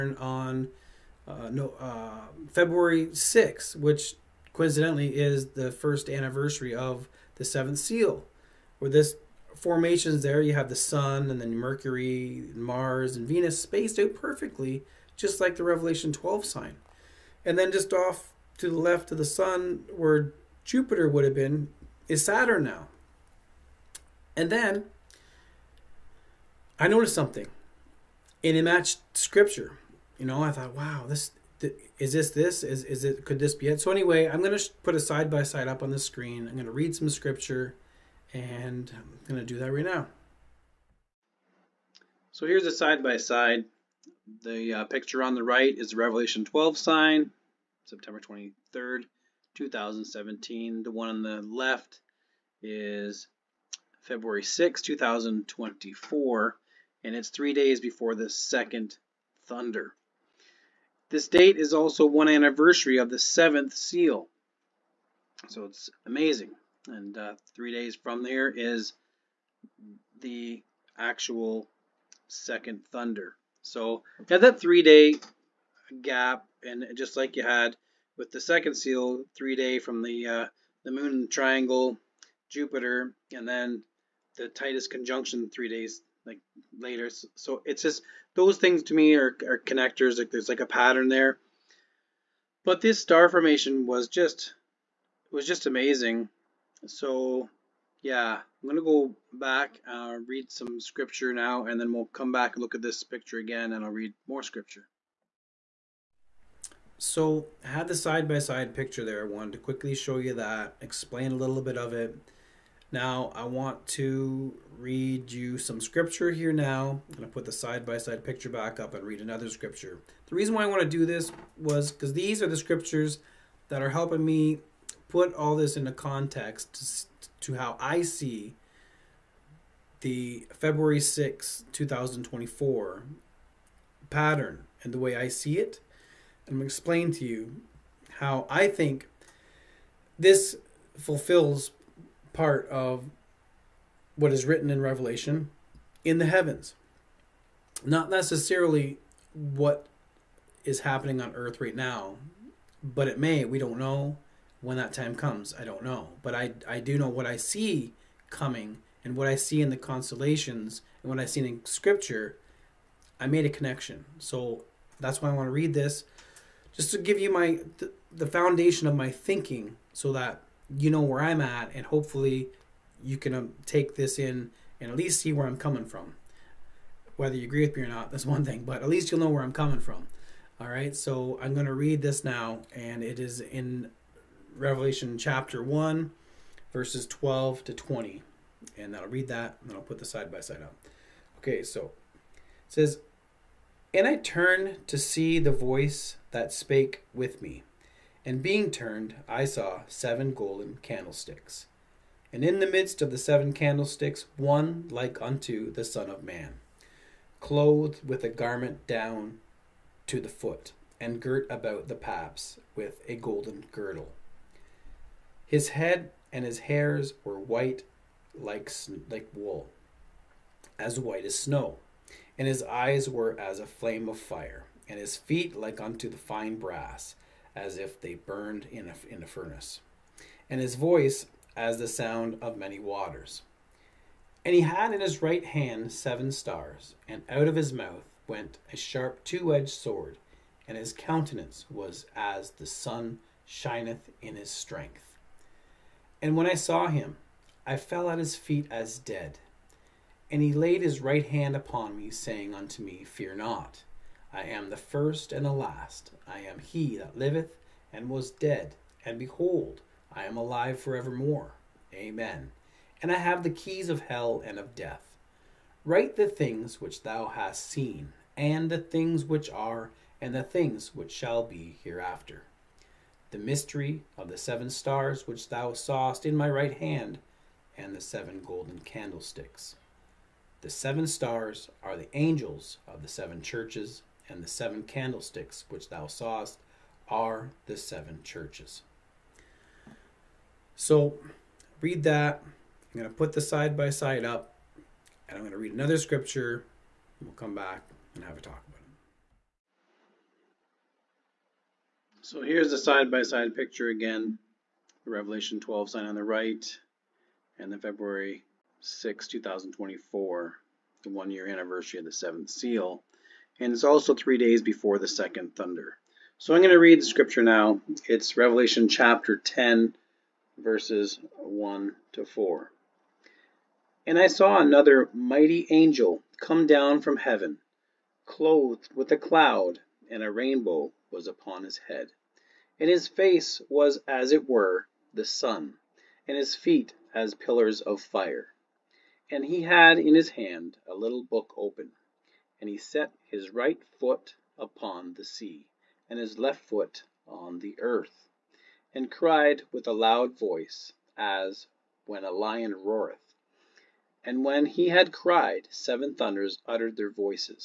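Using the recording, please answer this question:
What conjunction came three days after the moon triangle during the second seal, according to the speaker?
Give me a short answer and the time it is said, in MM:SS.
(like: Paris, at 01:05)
Titus conjunction, at 01:24.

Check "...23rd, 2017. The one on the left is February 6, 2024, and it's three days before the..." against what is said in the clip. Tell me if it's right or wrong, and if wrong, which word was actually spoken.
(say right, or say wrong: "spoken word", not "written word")
right.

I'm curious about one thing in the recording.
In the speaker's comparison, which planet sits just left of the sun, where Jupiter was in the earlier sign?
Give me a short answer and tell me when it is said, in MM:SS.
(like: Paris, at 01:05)
Saturn, at 00:22.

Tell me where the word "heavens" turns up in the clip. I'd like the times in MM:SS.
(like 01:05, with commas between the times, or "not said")
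02:26, 05:27.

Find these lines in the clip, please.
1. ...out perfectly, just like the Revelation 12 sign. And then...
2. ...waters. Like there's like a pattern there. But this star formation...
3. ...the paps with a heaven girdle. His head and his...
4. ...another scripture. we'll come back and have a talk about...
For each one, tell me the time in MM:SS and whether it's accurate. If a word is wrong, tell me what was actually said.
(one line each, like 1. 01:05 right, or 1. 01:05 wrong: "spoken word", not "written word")
1. 00:13 right
2. 01:29 wrong: "connectors", not "waters"
3. 03:31 wrong: "golden", not "heaven"
4. 04:55 right.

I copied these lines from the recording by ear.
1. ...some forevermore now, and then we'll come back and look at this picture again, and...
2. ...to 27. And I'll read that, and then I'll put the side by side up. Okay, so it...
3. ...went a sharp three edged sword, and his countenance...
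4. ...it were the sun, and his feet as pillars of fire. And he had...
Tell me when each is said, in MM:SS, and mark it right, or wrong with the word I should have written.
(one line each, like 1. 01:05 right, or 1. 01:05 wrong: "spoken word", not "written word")
1. 01:40 wrong: "scripture", not "forevermore"
2. 03:07 wrong: "20", not "27"
3. 03:58 wrong: "two", not "three"
4. 05:34 right.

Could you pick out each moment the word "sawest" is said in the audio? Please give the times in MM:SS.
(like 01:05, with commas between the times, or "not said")
04:35, 04:46.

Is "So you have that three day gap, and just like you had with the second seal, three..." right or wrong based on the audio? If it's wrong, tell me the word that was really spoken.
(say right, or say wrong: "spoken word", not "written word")
right.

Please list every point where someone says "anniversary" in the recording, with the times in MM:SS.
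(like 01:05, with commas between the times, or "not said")
00:06, 01:02, 05:11.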